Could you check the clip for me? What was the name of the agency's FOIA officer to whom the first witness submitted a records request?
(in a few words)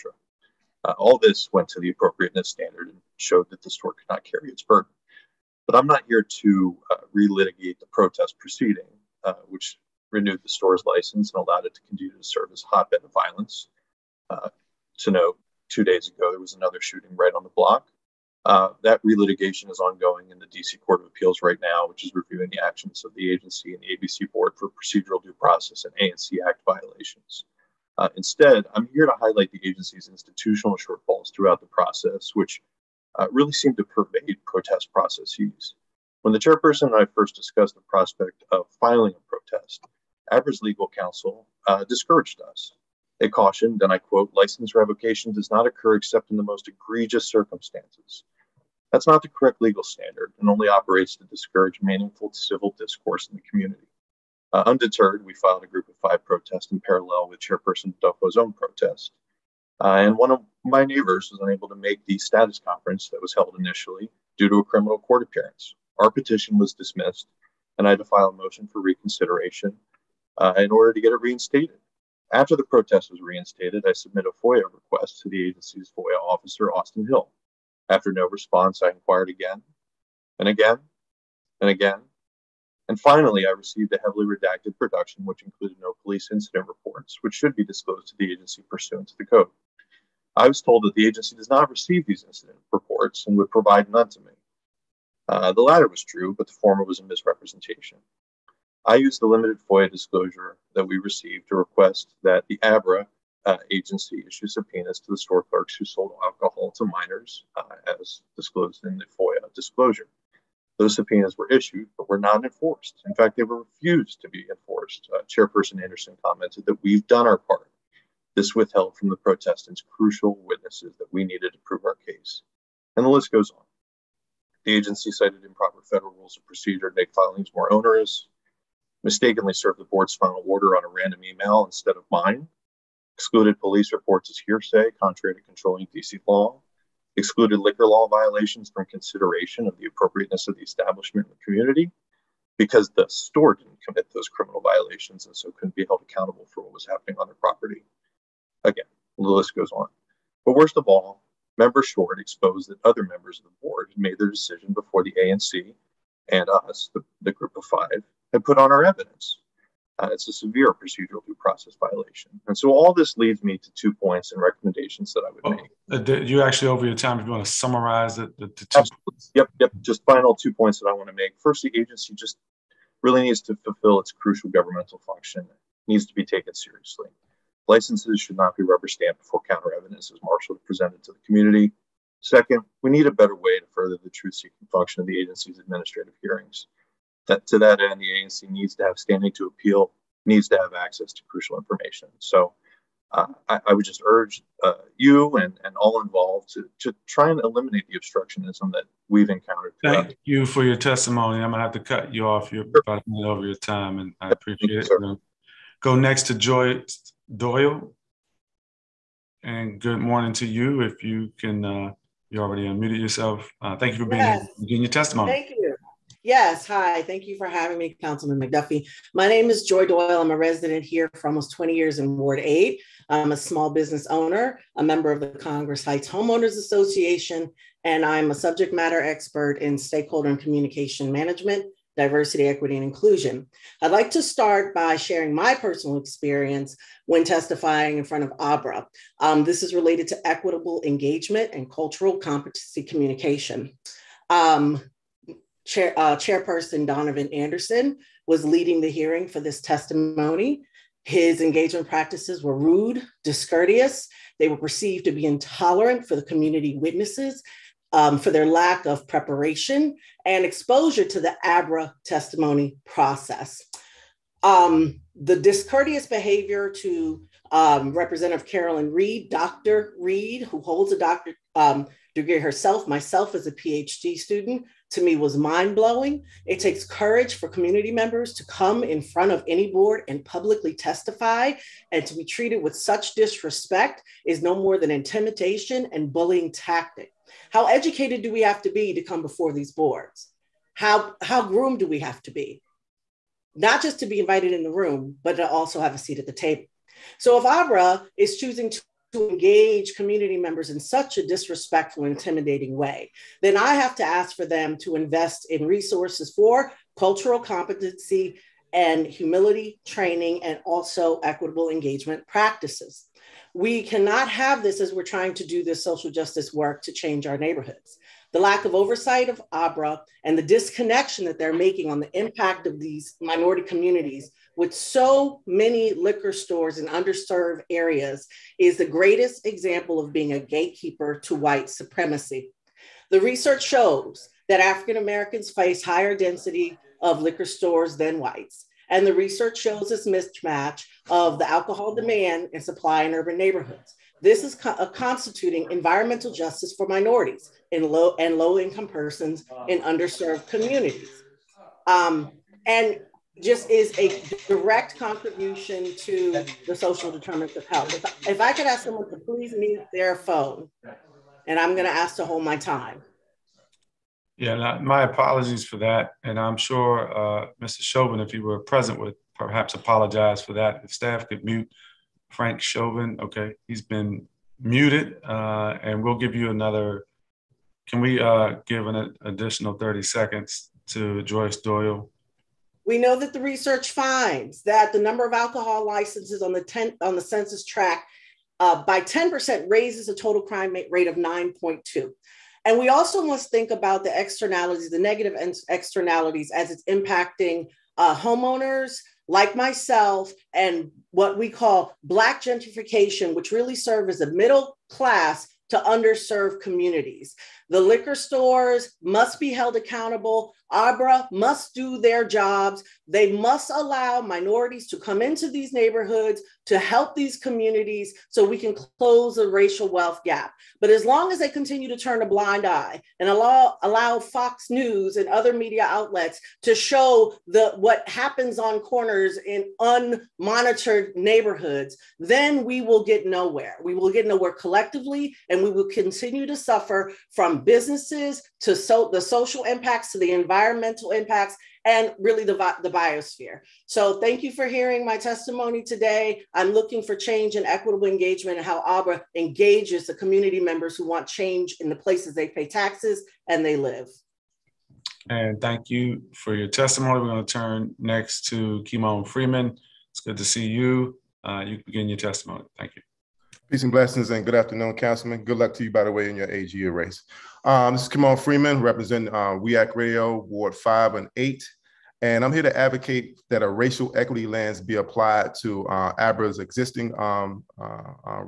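Austin Hill.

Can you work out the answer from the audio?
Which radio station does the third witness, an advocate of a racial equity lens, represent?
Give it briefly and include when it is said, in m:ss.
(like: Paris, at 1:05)
WEAC Radio, at 7:49.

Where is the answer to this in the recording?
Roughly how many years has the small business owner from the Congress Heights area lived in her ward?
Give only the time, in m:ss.
3:41.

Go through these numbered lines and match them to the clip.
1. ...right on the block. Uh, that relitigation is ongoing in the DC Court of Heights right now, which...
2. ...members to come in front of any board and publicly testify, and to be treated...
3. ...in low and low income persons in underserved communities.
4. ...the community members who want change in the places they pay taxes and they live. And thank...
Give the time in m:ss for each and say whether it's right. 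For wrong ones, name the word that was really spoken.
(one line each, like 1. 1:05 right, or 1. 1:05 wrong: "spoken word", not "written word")
1. 0:17 wrong: "Appeals", not "Heights"
2. 4:37 right
3. 5:47 right
4. 7:30 right.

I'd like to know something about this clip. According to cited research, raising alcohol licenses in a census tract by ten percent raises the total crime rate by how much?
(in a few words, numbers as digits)
9.2.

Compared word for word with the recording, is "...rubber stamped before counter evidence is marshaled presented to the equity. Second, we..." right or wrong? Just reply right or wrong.
wrong.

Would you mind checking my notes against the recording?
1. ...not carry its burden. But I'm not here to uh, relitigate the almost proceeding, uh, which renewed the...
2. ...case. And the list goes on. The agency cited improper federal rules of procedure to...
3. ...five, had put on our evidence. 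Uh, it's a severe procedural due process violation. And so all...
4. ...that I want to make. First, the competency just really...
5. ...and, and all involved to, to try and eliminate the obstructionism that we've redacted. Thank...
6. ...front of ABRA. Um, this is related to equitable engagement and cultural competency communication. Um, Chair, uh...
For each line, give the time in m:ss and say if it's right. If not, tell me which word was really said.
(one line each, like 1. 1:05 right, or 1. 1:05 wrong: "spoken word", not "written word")
1. 0:04 wrong: "protest", not "almost"
2. 2:02 right
3. 2:37 right
4. 2:50 wrong: "agency", not "competency"
5. 3:15 wrong: "encountered", not "redacted"
6. 3:58 right.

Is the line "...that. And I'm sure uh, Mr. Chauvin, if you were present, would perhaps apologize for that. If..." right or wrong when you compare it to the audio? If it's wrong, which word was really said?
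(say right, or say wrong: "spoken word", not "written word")
right.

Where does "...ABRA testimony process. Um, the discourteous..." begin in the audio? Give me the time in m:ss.
4:21.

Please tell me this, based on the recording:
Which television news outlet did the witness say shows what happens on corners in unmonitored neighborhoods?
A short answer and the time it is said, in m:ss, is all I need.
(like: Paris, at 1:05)
Fox News, at 7:04.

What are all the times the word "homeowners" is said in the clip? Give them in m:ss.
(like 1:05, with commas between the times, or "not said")
3:46, 6:38.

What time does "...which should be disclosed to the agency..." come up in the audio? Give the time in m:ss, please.
1:27.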